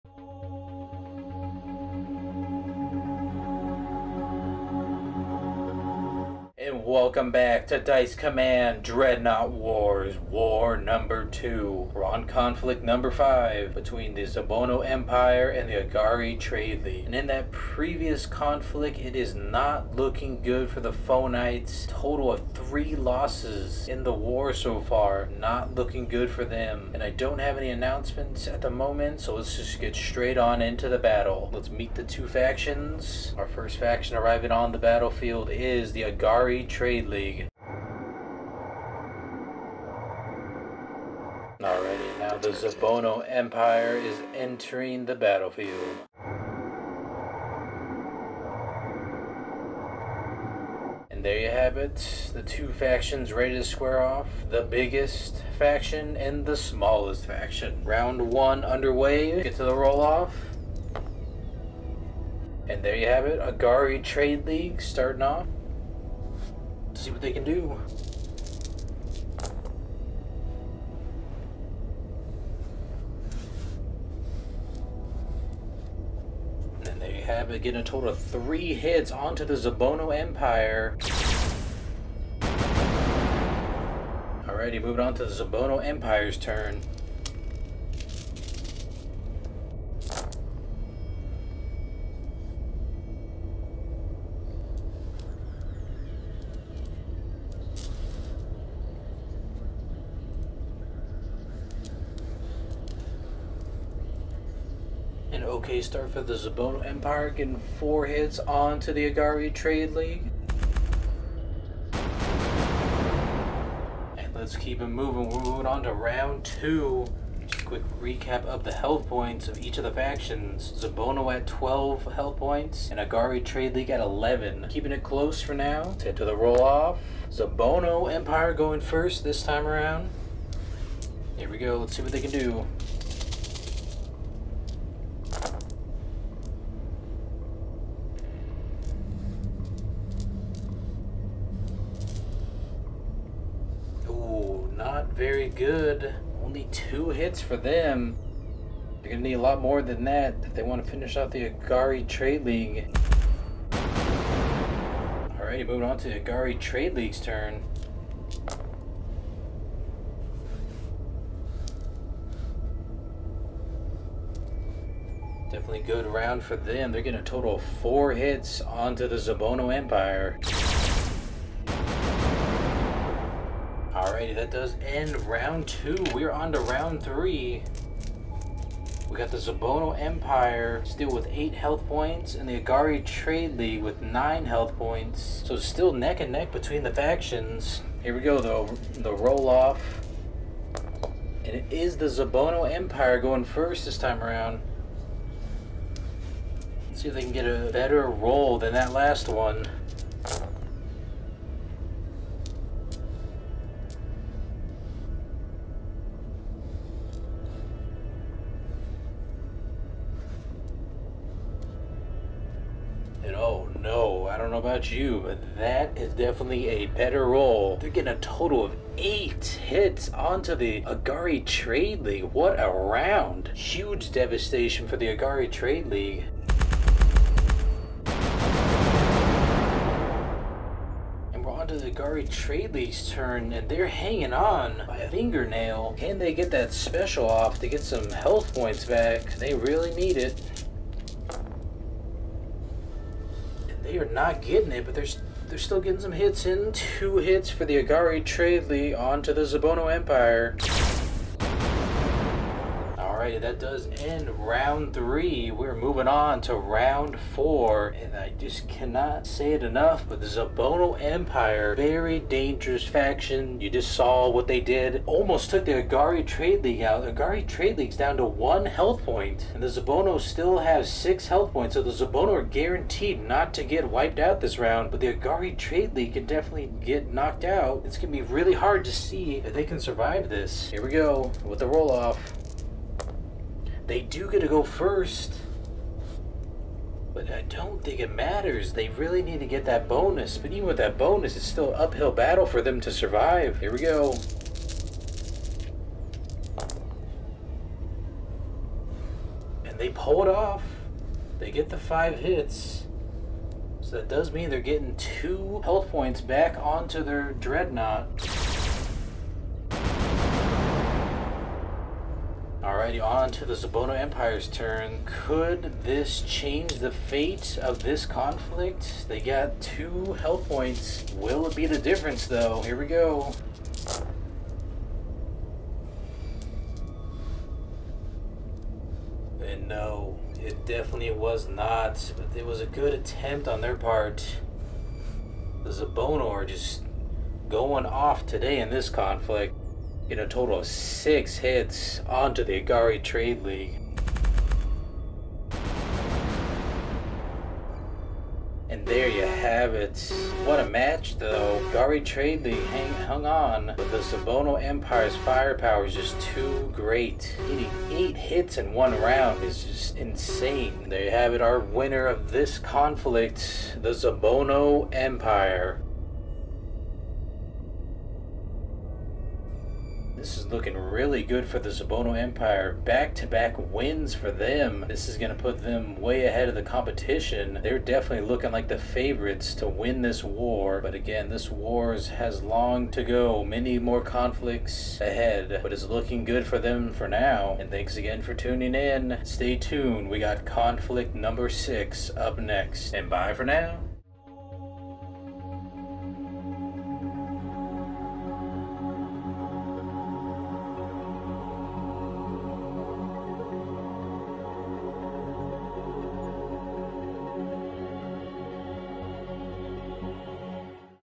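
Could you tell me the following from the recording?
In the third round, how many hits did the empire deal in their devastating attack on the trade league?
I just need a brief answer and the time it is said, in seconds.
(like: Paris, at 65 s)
8, at 218 s.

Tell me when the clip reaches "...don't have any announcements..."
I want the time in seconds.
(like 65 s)
27 s.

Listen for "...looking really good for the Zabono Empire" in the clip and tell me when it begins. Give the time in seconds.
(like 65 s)
370 s.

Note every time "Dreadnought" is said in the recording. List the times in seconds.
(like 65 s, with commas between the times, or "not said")
8 s, 307 s.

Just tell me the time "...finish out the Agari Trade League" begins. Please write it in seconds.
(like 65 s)
150 s.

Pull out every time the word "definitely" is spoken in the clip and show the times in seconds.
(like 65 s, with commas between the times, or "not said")
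165 s, 216 s, 276 s, 330 s, 377 s.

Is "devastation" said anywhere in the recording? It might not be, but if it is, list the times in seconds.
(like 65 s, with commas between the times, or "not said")
224 s.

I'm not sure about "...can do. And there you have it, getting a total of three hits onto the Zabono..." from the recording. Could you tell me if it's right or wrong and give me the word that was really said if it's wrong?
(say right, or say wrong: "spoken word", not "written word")
right.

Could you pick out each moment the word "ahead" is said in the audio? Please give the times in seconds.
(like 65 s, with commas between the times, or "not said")
376 s, 385 s.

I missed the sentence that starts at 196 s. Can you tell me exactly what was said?
Let's see if they can get a better roll than that last one.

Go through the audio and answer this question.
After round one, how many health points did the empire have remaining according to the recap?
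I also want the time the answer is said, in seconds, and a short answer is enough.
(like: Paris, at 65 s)
12, at 120 s.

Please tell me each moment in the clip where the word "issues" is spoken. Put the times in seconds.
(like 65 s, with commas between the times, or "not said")
not said.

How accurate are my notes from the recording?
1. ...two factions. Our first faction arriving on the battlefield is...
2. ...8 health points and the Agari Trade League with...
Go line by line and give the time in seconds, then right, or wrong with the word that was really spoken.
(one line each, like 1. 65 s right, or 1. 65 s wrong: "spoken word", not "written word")
1. 32 s right
2. 181 s right.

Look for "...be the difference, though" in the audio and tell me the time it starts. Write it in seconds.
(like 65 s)
321 s.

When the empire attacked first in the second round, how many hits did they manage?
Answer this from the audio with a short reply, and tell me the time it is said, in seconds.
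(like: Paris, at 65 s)
2, at 146 s.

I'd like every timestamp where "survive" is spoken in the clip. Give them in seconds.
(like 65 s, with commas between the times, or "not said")
279 s, 292 s.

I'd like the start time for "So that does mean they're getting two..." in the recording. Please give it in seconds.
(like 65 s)
303 s.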